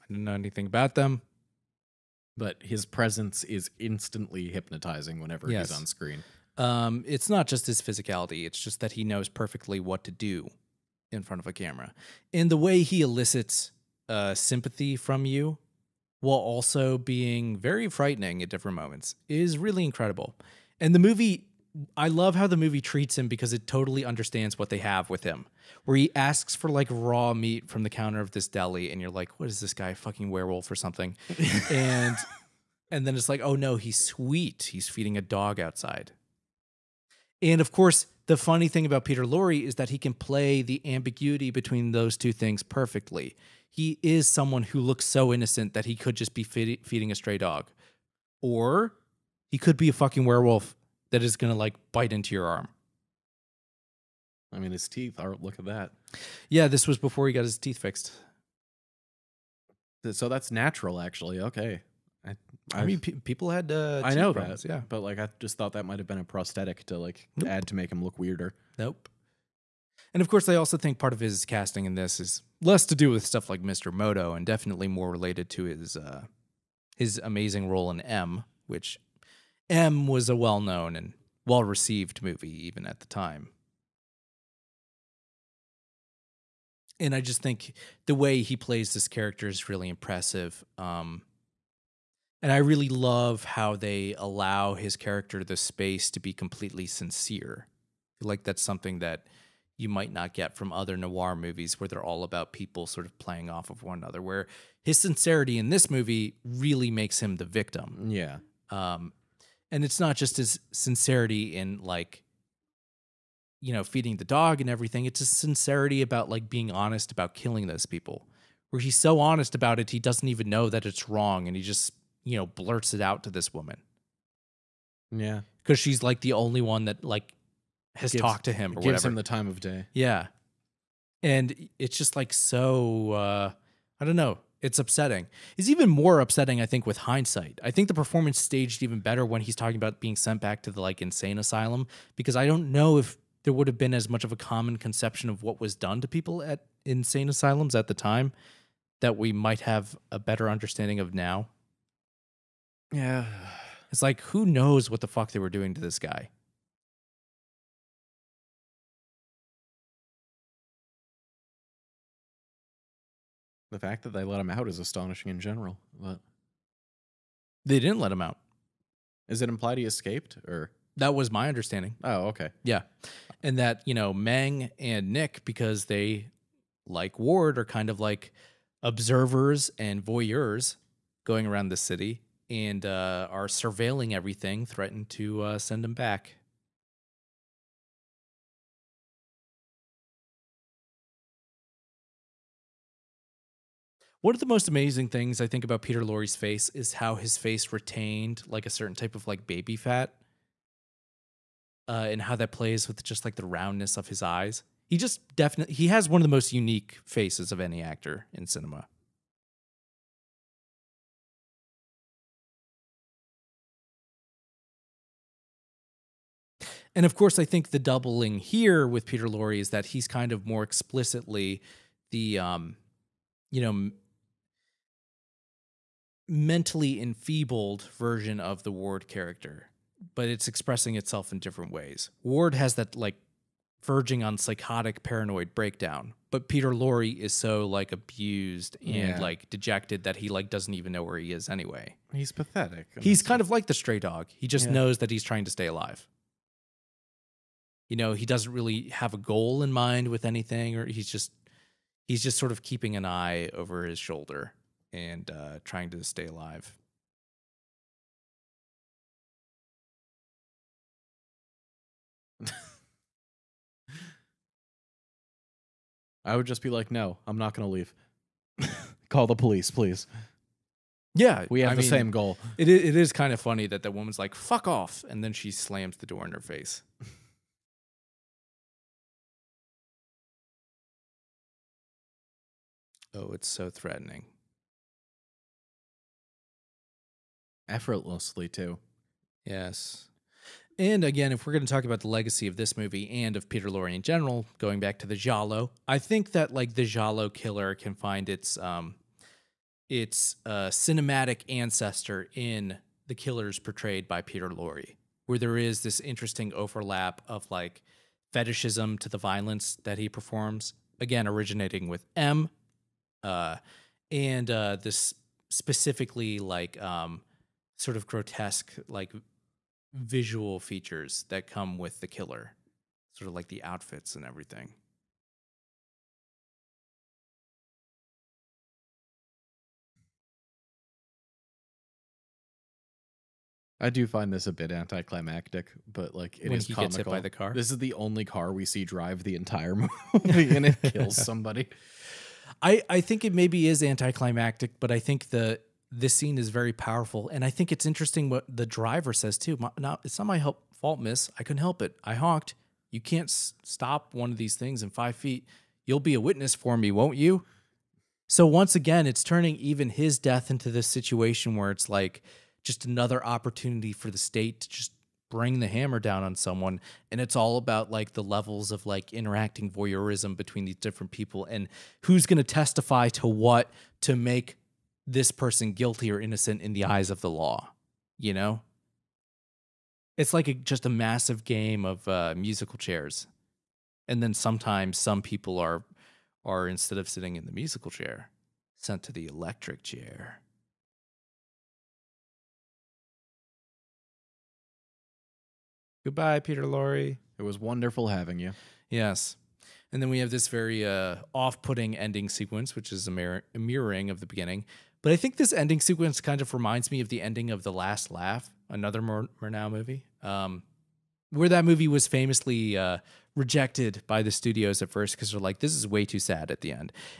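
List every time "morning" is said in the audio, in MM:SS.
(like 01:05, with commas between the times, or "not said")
not said.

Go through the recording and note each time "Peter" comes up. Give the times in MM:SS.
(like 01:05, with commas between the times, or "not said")
00:39, 03:15, 03:39, 03:56, 04:53, 05:04, 06:36.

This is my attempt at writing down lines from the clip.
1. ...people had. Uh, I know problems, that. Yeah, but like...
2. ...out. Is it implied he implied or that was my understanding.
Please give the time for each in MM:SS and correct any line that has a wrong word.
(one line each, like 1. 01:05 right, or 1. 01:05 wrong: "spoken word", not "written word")
1. 01:03 right
2. 02:48 wrong: "escaped", not "implied".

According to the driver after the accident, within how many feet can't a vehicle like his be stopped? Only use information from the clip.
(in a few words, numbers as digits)
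5.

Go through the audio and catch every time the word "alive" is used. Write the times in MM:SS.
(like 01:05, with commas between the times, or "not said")
04:05, 04:16.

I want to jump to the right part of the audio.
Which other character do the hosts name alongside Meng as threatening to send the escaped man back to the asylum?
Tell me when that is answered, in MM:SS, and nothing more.
02:55.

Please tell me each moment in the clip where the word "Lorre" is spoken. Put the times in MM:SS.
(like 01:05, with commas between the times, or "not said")
00:39, 03:16, 03:39, 03:56, 04:53, 05:04, 06:36.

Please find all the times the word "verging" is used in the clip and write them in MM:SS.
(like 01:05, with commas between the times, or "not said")
03:53.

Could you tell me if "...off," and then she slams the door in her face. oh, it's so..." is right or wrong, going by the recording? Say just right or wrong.
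right.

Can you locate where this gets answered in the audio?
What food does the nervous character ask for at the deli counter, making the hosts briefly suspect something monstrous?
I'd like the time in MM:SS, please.
00:26.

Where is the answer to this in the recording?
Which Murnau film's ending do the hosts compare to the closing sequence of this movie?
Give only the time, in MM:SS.
06:47.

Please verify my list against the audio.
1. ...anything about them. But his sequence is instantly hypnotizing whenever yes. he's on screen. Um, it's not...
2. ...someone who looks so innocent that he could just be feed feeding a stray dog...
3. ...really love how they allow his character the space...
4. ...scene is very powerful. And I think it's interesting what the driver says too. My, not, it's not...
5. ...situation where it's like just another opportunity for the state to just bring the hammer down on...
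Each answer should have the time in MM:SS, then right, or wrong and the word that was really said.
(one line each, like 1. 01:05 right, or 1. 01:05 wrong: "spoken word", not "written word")
1. 00:00 wrong: "presence", not "sequence"
2. 00:44 right
3. 01:32 right
4. 05:46 right
5. 06:00 right.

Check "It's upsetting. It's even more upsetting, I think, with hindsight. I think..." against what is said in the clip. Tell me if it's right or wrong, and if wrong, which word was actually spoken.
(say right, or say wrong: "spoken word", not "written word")
right.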